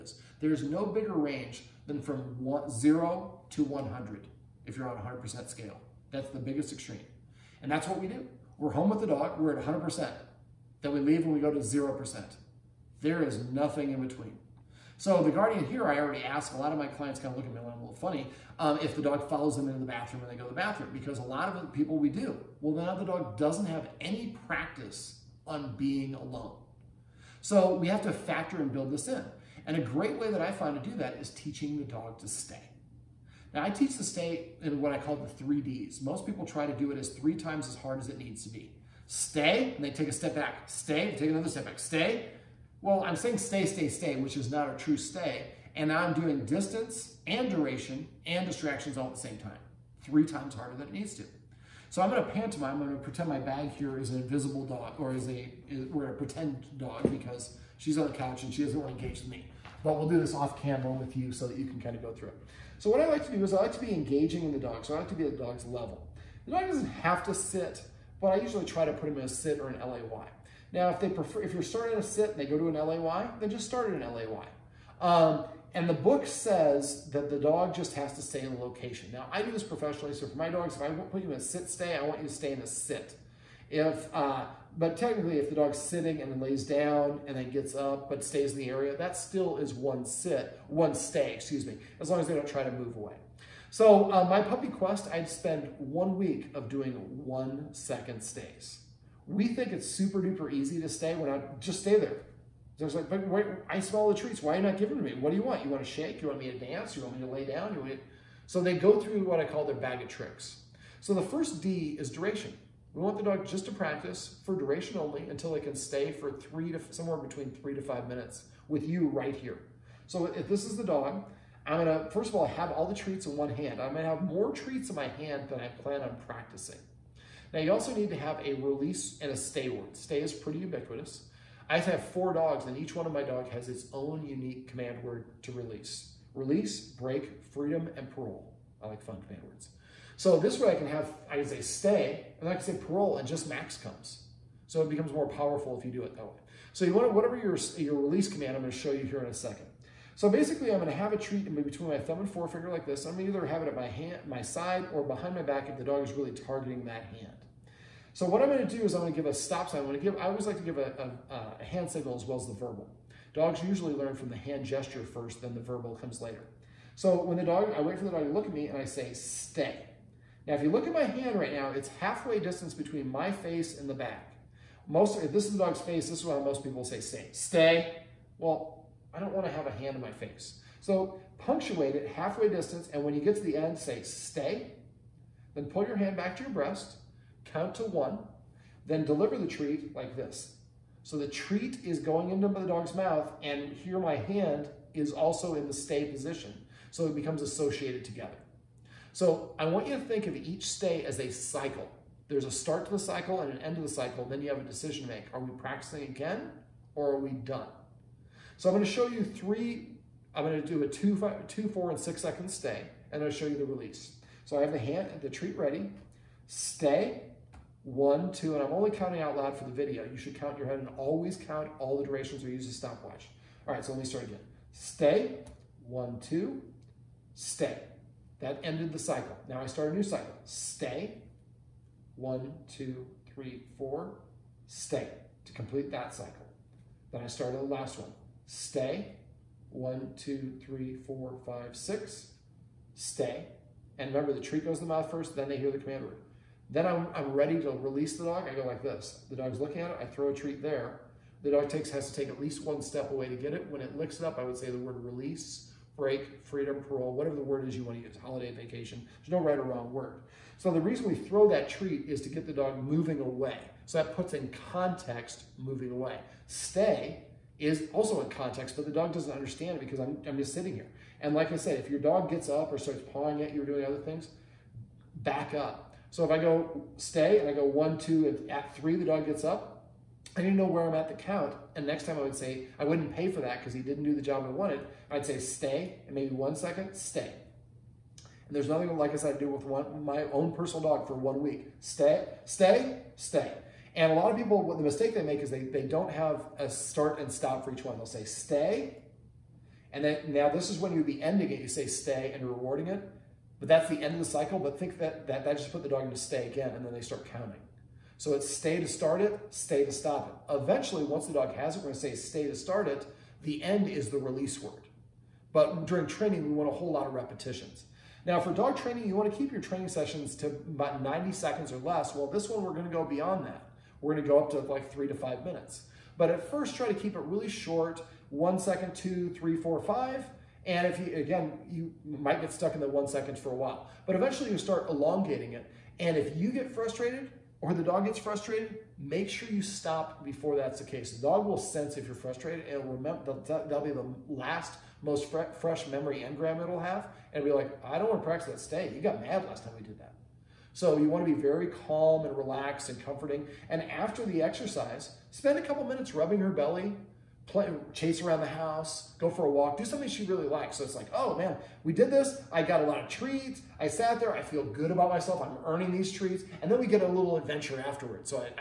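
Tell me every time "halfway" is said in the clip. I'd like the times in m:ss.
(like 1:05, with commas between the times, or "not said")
2:52, 3:02.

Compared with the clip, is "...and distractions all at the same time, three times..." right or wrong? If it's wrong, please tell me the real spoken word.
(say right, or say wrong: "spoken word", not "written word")
right.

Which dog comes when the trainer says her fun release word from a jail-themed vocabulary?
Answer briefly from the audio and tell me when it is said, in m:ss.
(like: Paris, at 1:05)
Max, at 2:23.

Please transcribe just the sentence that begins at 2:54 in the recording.
Most, if this is the dog's face, this is why most people say stay.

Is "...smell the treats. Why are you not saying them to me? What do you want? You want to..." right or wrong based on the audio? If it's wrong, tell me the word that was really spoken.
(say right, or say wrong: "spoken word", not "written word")
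wrong: "giving", not "saying".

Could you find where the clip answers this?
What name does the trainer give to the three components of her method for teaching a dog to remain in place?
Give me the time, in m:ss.
0:35.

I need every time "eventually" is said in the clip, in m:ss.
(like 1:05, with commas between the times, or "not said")
5:10, 5:34.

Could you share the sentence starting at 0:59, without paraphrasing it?
But we'll do this off camera with you so that you can kind of go through it.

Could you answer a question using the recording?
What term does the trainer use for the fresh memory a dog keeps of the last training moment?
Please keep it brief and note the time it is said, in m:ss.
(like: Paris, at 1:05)
memory engram, at 5:45.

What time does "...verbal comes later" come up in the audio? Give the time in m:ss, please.
2:45.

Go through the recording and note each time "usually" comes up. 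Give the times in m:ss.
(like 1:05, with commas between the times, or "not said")
1:08, 2:43.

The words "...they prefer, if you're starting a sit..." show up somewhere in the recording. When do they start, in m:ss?
1:11.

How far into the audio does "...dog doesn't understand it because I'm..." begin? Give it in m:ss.
4:28.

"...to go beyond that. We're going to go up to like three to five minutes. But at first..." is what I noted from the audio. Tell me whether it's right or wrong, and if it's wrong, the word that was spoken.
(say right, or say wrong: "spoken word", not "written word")
right.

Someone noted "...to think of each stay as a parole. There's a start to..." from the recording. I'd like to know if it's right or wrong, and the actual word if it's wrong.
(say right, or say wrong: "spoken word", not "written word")
wrong: "cycle", not "parole".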